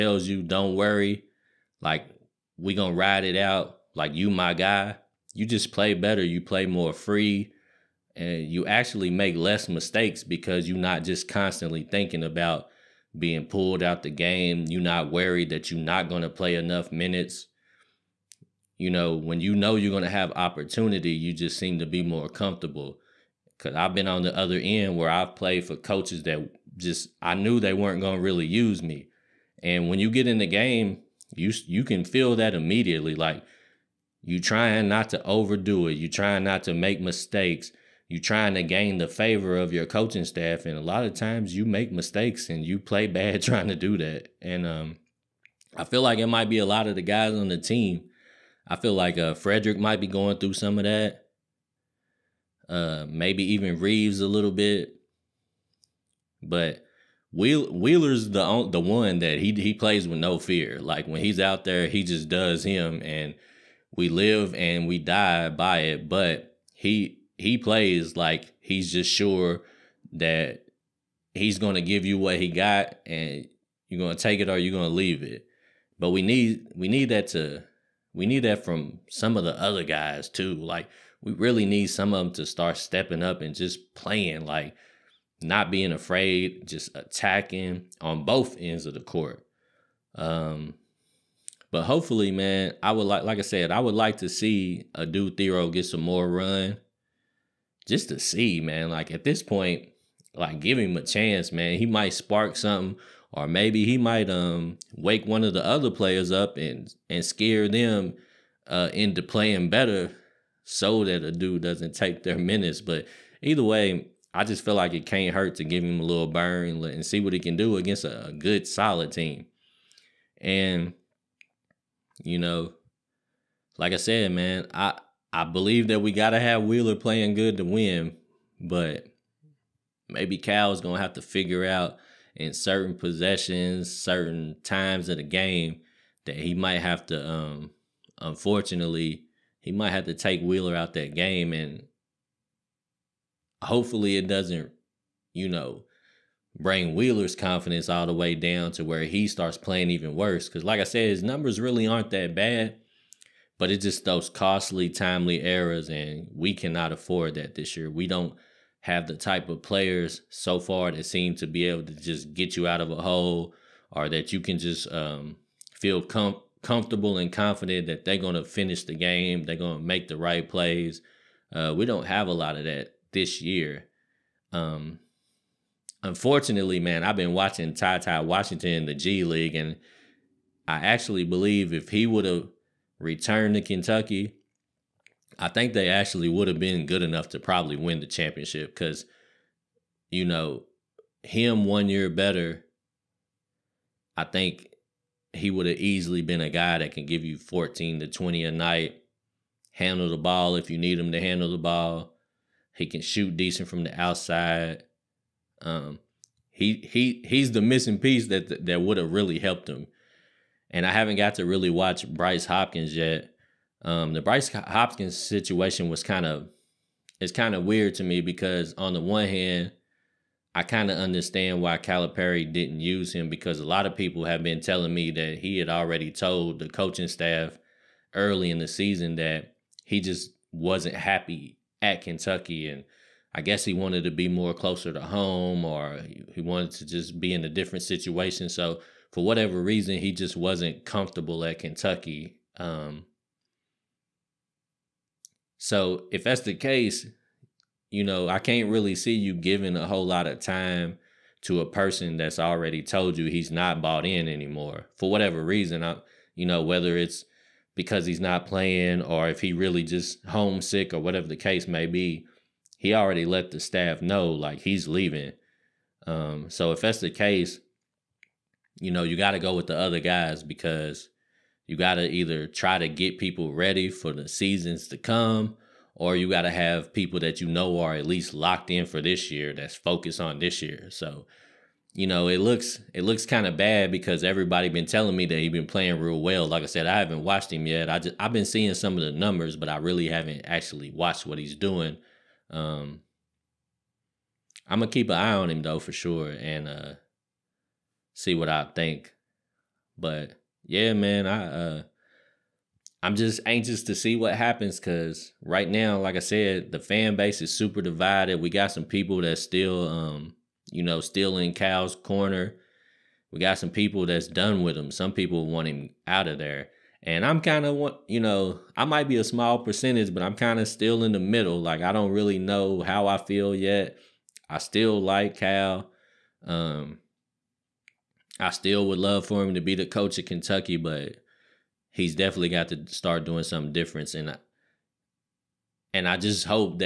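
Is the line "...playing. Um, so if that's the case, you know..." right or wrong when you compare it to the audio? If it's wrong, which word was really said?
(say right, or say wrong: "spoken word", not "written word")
wrong: "leaving", not "playing".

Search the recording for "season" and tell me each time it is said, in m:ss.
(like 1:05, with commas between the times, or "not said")
3:48, 4:34.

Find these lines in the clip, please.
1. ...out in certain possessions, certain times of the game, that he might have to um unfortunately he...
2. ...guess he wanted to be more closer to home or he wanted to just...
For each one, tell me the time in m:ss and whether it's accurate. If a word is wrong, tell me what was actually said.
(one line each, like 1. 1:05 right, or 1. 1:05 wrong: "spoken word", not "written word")
1. 2:11 right
2. 3:53 right.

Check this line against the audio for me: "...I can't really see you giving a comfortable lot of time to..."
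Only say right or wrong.
wrong.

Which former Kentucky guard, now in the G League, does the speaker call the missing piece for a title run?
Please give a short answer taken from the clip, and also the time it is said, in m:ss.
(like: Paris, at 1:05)
Ty Washington, at 2:57.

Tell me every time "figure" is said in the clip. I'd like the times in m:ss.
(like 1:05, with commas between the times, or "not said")
2:11.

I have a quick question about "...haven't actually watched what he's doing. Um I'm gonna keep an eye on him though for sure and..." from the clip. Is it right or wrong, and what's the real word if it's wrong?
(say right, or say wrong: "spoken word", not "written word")
right.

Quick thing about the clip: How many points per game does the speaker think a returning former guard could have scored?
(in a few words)
14 to 20.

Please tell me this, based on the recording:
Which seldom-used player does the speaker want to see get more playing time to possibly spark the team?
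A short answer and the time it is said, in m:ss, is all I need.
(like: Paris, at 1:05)
Adou Thiero, at 1:34.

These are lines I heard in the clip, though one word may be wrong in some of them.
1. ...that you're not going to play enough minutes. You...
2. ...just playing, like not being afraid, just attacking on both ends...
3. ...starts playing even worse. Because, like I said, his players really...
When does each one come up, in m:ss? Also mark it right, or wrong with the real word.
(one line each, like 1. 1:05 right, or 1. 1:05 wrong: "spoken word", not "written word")
1. 0:15 right
2. 1:23 right
3. 2:29 wrong: "numbers", not "players".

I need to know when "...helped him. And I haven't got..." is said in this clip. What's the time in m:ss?
3:29.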